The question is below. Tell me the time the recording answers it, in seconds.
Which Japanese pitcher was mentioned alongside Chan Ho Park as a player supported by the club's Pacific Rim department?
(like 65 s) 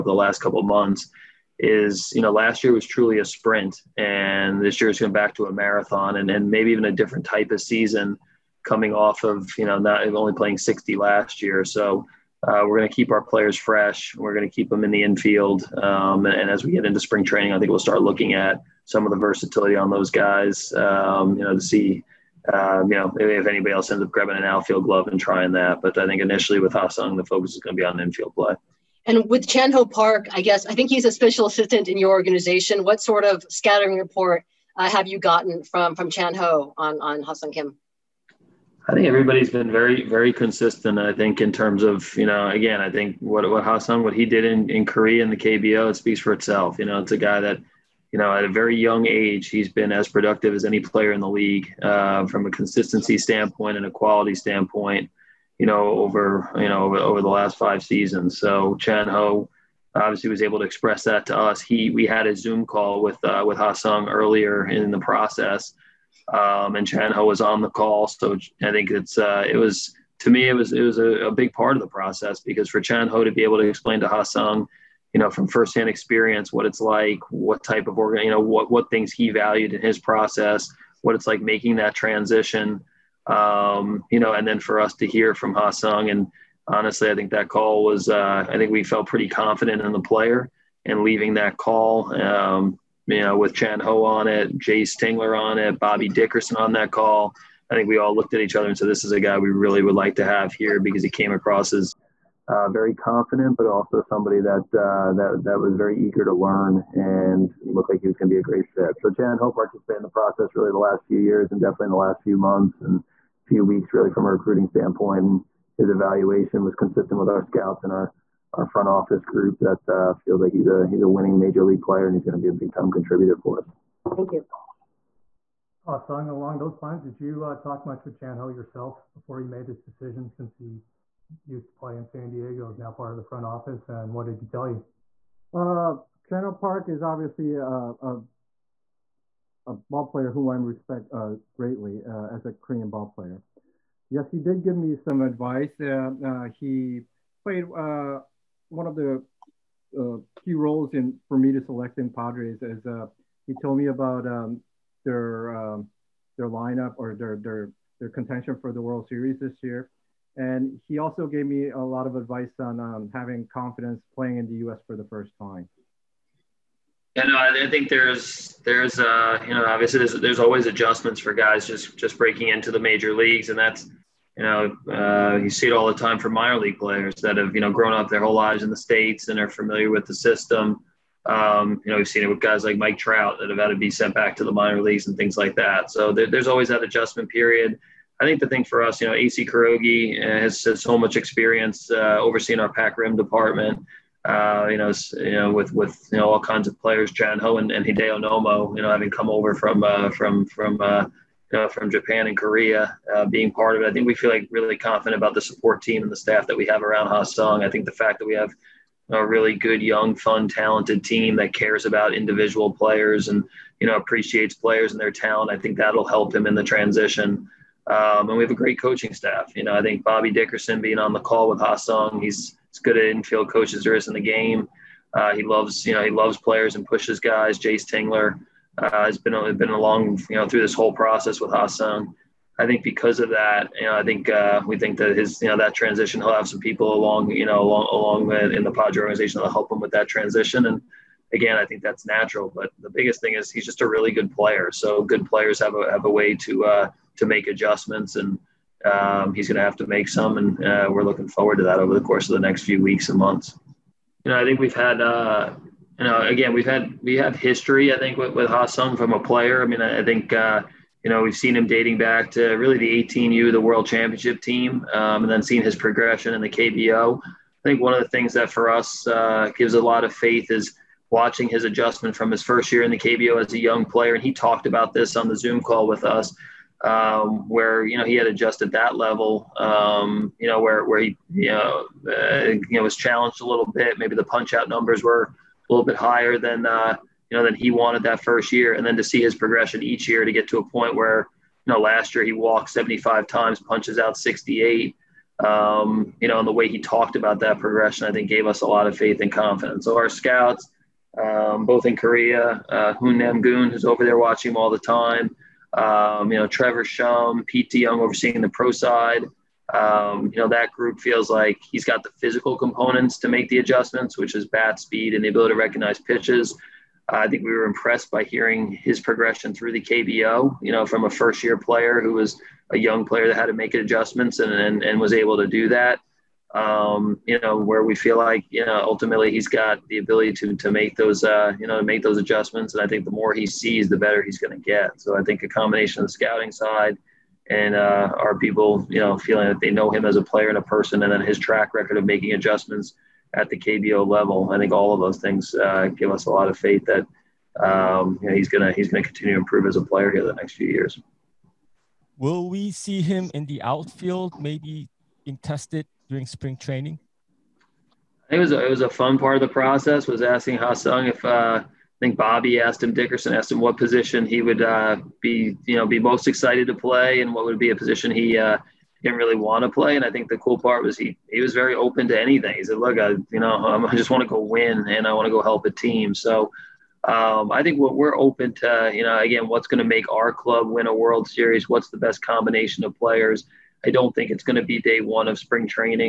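197 s.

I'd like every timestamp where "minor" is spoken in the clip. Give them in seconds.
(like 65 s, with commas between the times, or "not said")
176 s, 184 s.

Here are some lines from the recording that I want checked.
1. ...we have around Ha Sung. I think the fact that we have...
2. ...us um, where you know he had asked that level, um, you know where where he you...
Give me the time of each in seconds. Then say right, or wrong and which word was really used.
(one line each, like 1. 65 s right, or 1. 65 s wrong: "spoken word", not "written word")
1. 206 s right
2. 276 s wrong: "adjusted", not "asked".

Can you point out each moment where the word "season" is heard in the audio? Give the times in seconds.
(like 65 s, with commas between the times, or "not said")
7 s, 57 s.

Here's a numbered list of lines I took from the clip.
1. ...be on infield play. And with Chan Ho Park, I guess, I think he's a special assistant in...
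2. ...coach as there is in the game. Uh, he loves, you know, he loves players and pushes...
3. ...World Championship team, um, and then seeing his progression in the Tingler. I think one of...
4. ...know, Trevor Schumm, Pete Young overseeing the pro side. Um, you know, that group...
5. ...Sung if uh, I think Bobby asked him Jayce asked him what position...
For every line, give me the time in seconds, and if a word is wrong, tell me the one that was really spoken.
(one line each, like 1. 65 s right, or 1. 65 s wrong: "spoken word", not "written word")
1. 27 s right
2. 223 s right
3. 263 s wrong: "KBO", not "Tingler"
4. 306 s right
5. 360 s wrong: "Dickerson", not "Jayce".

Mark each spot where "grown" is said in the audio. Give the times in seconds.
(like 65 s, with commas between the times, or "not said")
177 s.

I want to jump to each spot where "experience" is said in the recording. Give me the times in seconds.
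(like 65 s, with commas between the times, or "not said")
75 s, 191 s.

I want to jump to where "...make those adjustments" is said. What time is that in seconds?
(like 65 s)
331 s.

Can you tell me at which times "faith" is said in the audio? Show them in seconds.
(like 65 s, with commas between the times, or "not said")
270 s, 298 s, 346 s.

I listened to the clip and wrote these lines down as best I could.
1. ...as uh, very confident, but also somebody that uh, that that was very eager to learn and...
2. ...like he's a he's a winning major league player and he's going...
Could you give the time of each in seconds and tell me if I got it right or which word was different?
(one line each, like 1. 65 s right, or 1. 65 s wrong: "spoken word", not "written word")
1. 101 s right
2. 120 s right.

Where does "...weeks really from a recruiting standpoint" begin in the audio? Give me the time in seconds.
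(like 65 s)
113 s.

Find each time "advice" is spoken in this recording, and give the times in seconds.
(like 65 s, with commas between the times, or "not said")
145 s, 162 s.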